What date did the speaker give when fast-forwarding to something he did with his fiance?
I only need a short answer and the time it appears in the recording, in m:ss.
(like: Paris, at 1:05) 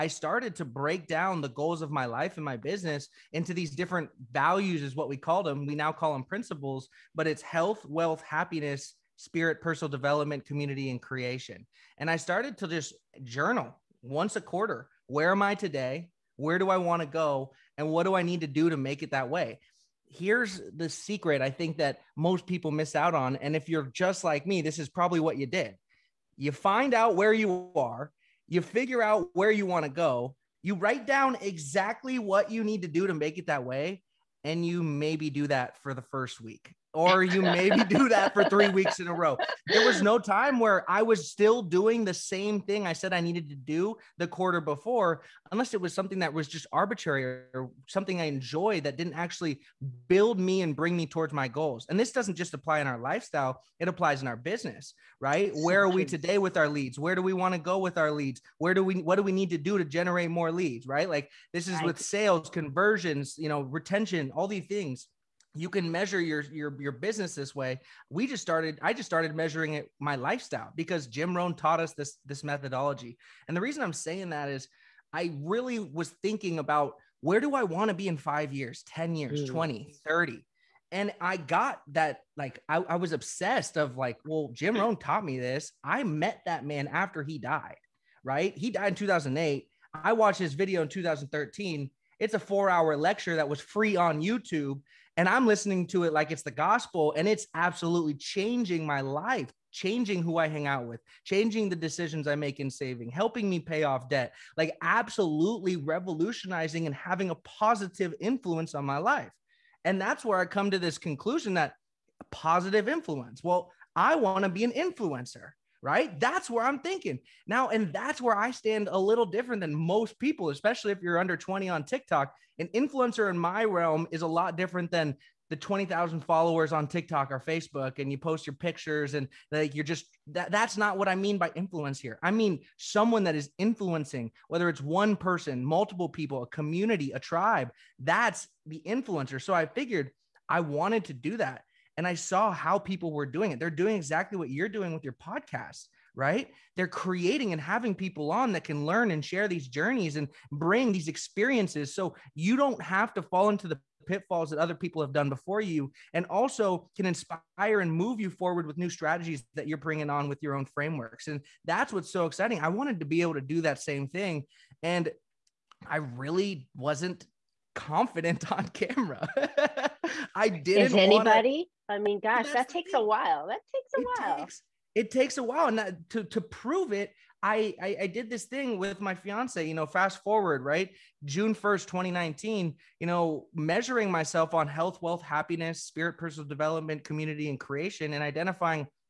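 June 1, 2019, at 3:01.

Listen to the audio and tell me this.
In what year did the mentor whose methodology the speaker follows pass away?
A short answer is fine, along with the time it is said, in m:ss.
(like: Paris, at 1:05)
2008, at 1:28.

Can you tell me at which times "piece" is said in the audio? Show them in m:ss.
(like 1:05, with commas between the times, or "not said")
not said.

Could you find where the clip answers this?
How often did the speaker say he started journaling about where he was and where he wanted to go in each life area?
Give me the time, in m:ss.
0:14.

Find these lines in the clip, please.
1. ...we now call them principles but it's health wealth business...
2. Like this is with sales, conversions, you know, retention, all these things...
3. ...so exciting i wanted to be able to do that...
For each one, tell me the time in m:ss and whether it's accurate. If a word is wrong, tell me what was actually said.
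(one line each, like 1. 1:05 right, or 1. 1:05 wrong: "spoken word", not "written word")
1. 0:05 wrong: "happiness", not "business"
2. 1:01 right
3. 2:42 right.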